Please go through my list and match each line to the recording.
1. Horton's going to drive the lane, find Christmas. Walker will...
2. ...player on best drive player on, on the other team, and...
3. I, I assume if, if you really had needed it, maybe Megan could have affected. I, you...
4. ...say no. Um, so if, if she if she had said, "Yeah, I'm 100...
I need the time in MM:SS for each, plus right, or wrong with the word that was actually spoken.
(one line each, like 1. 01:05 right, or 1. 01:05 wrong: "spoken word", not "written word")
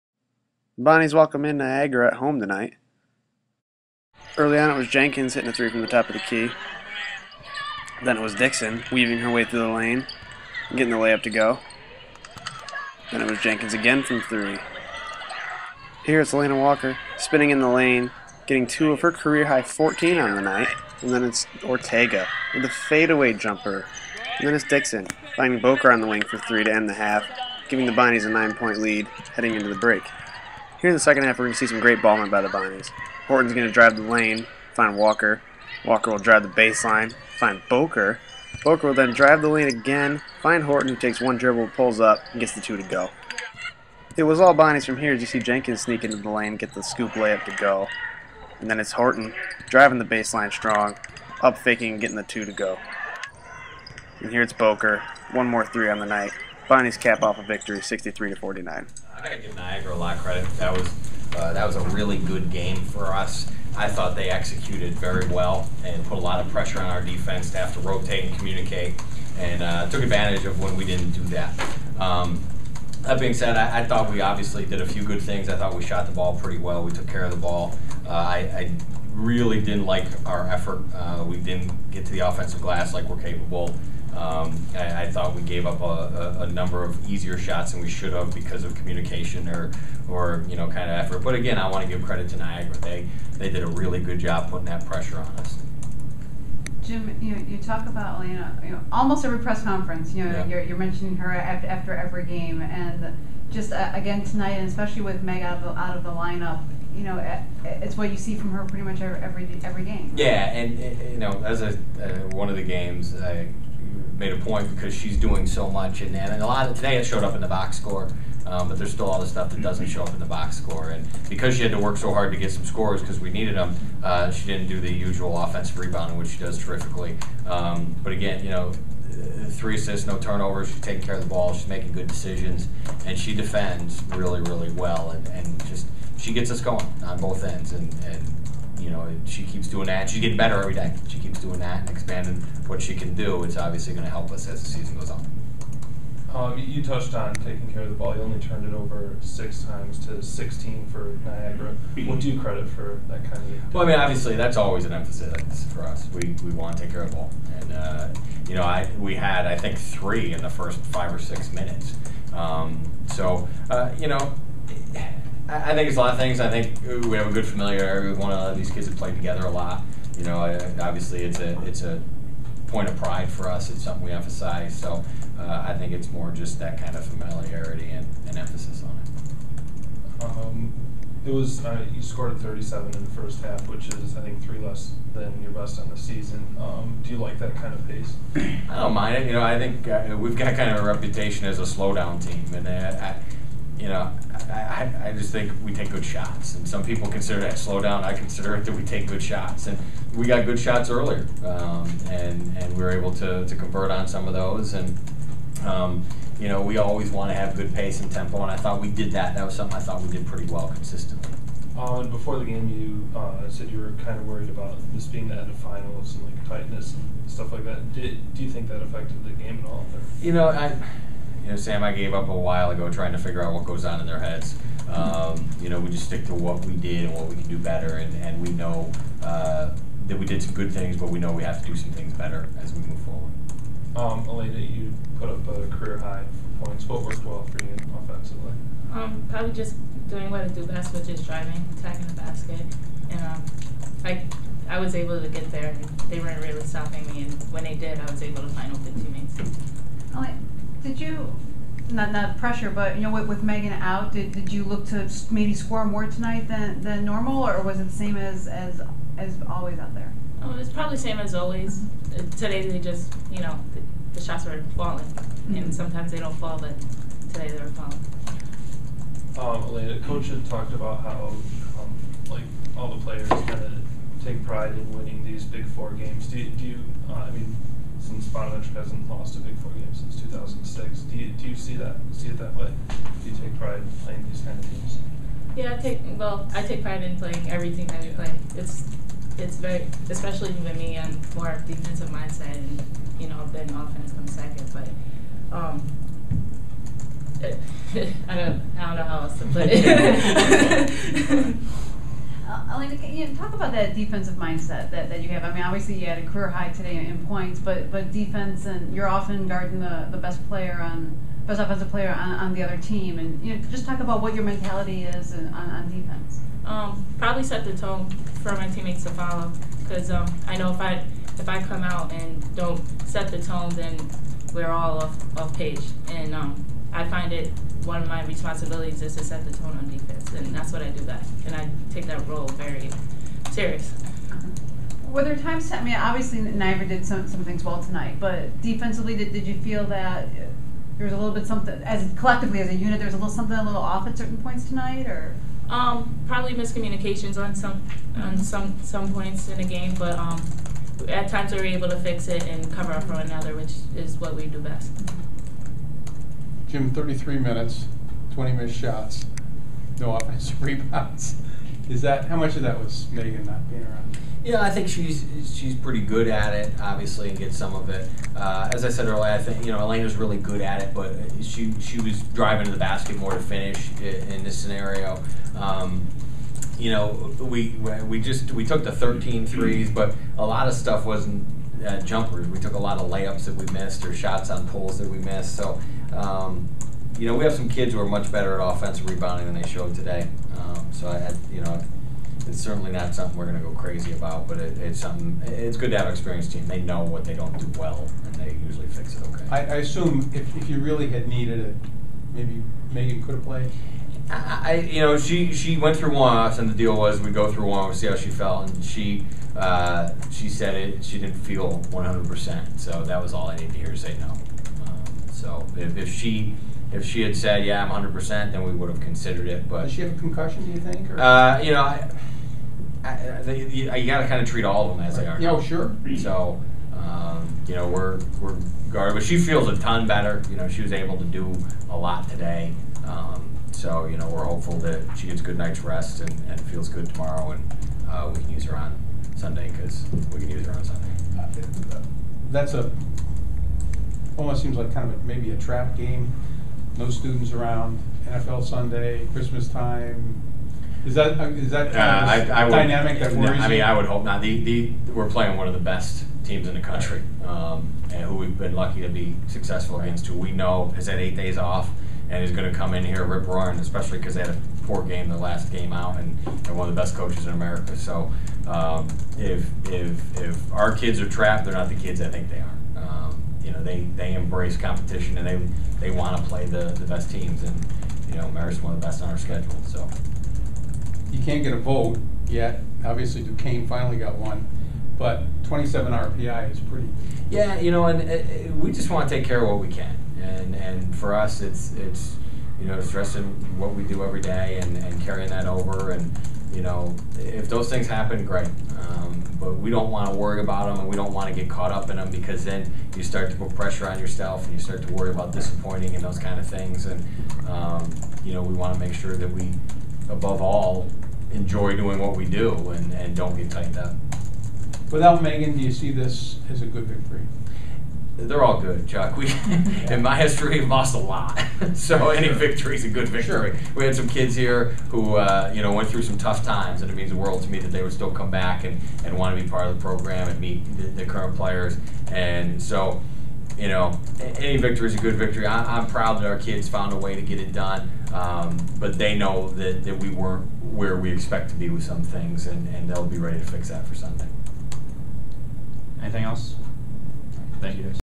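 1. 00:33 wrong: "Walker", not "Christmas"
2. 05:10 wrong: "offensive", not "drive"
3. 06:39 wrong: "played", not "affected"
4. 06:53 right.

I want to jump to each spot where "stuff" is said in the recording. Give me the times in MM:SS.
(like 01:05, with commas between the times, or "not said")
01:59, 03:37, 06:20.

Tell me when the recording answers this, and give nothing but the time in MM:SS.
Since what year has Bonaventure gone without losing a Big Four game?
04:40.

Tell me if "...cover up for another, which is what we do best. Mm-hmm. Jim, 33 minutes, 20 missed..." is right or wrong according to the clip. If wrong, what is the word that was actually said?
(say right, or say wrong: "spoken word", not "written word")
right.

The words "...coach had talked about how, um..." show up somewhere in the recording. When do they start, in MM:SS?
04:30.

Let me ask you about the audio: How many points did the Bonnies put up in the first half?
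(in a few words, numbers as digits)
37.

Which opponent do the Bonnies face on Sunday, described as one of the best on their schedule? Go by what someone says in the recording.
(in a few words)
Marist.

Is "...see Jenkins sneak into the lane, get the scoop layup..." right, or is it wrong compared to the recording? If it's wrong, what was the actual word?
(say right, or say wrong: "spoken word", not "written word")
right.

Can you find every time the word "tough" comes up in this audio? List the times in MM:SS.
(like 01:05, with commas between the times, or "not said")
08:46.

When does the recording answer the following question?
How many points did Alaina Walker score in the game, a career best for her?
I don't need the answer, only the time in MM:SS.
00:19.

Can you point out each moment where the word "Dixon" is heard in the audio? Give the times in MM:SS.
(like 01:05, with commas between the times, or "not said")
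00:08, 00:24.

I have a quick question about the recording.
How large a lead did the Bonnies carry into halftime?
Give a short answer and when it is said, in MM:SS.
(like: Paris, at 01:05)
9 points, at 00:28.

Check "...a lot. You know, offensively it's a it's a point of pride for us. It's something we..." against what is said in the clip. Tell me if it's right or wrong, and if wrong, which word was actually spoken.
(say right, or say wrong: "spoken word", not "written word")
wrong: "obviously", not "offensively".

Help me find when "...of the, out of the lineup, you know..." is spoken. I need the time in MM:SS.
01:45.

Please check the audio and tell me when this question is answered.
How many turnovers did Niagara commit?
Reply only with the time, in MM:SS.
02:30.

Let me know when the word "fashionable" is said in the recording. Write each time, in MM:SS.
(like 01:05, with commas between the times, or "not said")
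not said.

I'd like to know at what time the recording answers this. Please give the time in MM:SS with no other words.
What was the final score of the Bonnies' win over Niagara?
00:57.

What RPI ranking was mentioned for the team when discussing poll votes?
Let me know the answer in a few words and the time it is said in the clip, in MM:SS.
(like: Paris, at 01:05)
27, at 08:05.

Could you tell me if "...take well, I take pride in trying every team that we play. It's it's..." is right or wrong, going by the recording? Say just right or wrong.
wrong.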